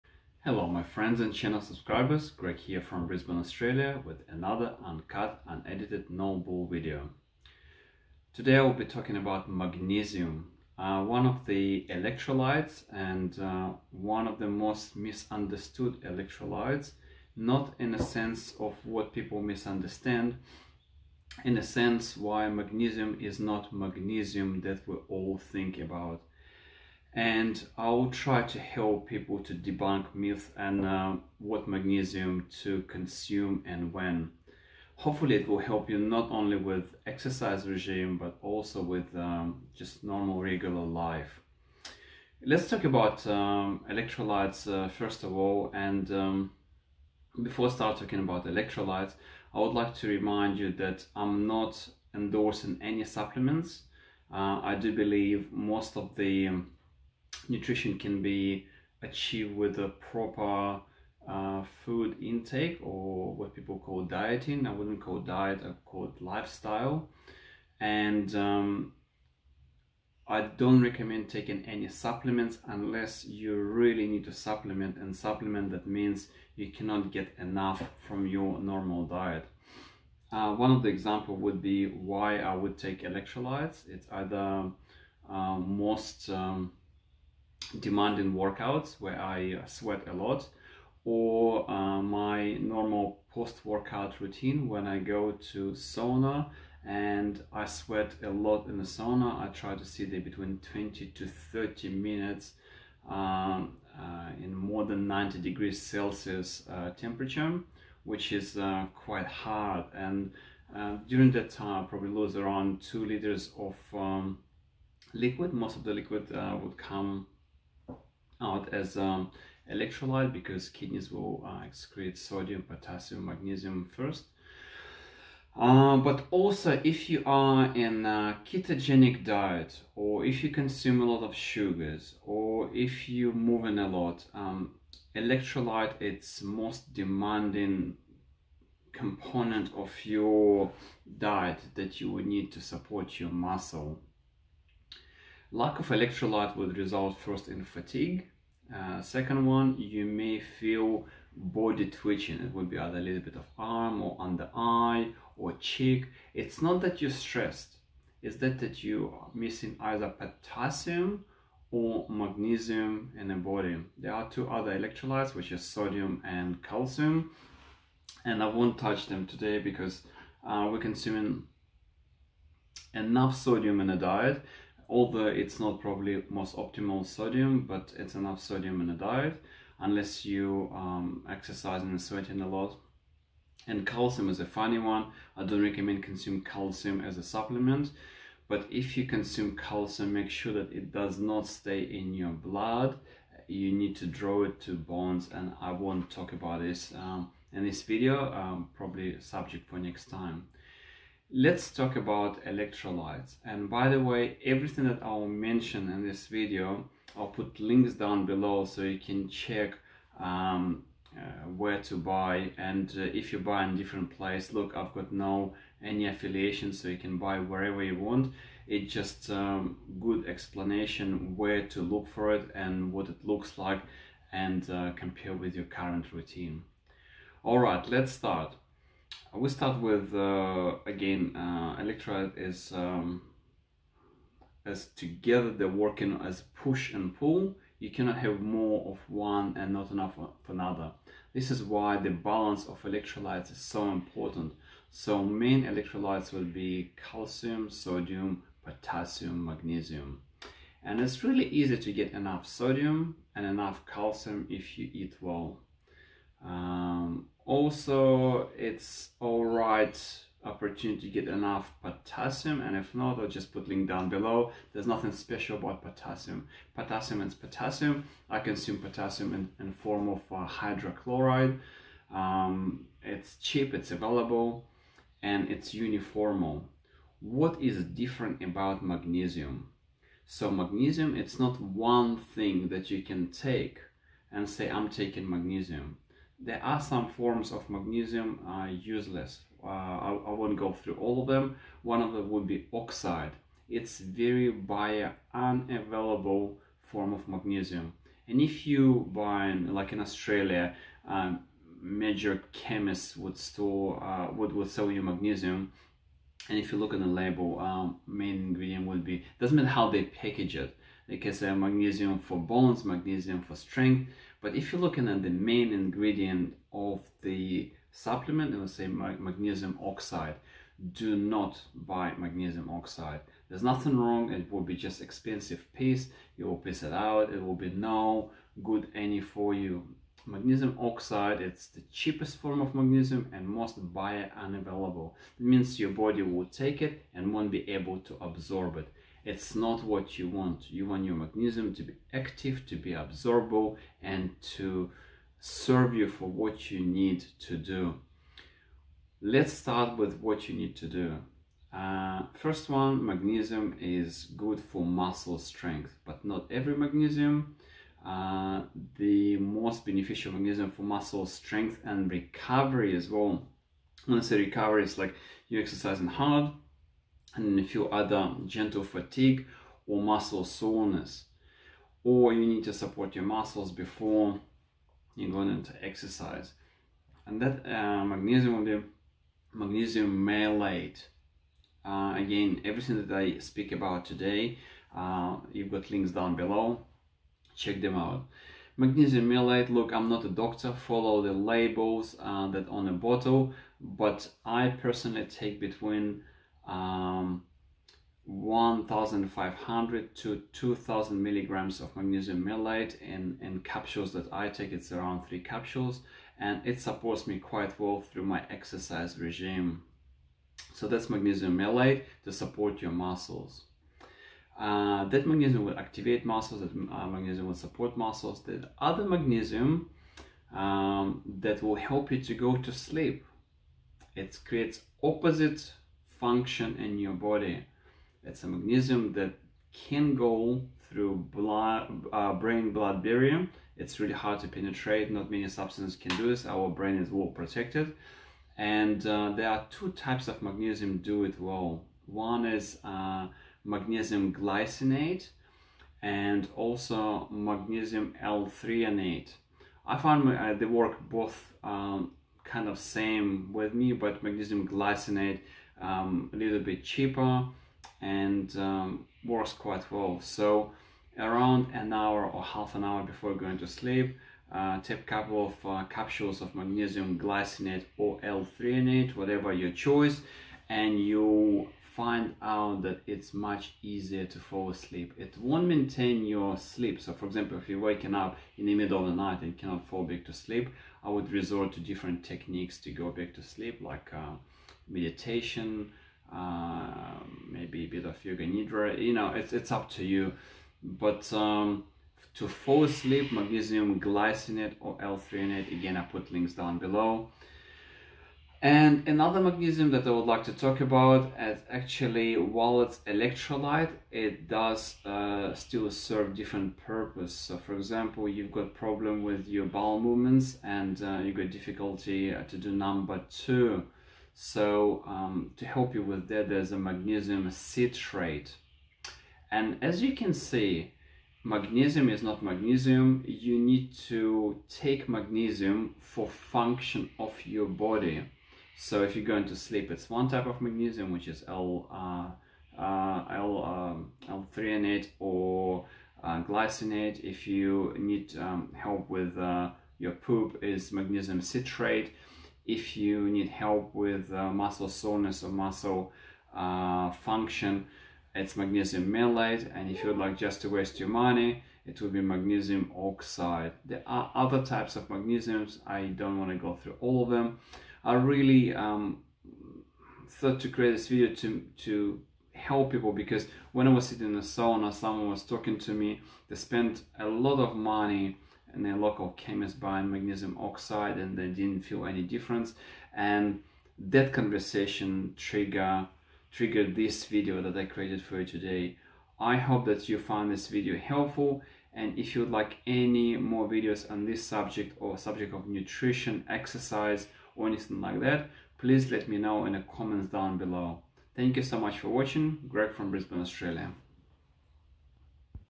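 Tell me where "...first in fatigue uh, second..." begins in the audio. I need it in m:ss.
2:27.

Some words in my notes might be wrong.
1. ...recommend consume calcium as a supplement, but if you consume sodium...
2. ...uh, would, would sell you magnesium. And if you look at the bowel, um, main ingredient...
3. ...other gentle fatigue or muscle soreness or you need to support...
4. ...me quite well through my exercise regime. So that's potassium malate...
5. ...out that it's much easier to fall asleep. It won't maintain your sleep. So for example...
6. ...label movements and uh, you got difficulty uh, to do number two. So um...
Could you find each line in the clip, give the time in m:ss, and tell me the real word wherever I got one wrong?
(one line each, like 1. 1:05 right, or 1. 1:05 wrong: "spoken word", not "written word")
1. 3:05 wrong: "calcium", not "sodium"
2. 5:04 wrong: "label", not "bowel"
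3. 6:07 right
4. 6:47 wrong: "magnesium", not "potassium"
5. 7:52 right
6. 8:29 wrong: "bowel", not "label".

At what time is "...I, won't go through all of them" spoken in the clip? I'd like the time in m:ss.
4:50.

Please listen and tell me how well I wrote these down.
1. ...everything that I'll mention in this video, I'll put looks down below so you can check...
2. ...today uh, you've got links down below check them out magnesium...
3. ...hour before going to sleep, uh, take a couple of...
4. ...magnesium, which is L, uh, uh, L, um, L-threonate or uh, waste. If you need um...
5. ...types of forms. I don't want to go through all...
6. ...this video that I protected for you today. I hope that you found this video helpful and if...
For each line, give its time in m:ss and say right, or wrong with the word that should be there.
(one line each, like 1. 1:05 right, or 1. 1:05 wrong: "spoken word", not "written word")
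1. 3:24 wrong: "links", not "looks"
2. 6:24 right
3. 7:42 right
4. 8:50 wrong: "glycinate", not "waste"
5. 9:14 wrong: "magnesiums", not "forms"
6. 9:36 wrong: "created", not "protected".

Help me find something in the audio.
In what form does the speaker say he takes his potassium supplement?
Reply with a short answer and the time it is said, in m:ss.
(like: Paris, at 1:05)
hydrochloride, at 4:30.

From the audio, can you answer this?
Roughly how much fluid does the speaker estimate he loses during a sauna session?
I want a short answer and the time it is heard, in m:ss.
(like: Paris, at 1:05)
2 liters, at 1:52.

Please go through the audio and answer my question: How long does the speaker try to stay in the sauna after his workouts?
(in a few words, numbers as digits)
20 to 30 minutes.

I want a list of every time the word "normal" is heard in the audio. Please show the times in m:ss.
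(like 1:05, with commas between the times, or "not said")
0:40, 1:18, 1:32.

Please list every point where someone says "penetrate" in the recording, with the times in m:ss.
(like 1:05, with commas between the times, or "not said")
7:14.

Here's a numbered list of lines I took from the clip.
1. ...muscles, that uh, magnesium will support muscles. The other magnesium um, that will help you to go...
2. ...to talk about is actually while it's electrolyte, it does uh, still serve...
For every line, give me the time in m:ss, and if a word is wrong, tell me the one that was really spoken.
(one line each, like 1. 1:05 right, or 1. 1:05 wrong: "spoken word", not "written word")
1. 6:56 right
2. 8:20 right.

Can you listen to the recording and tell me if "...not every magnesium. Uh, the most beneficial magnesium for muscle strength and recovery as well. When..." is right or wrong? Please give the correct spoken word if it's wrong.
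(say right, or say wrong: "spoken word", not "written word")
right.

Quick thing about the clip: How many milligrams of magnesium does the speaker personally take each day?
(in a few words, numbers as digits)
1500 to 2000.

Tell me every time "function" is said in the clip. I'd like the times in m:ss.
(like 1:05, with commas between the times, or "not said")
7:06, 8:46, 9:07.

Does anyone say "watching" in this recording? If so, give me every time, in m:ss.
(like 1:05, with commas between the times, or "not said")
9:52.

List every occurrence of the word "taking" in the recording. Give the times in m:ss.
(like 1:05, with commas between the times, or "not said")
1:11, 4:44.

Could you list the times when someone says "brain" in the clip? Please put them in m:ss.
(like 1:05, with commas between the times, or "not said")
7:12, 7:16.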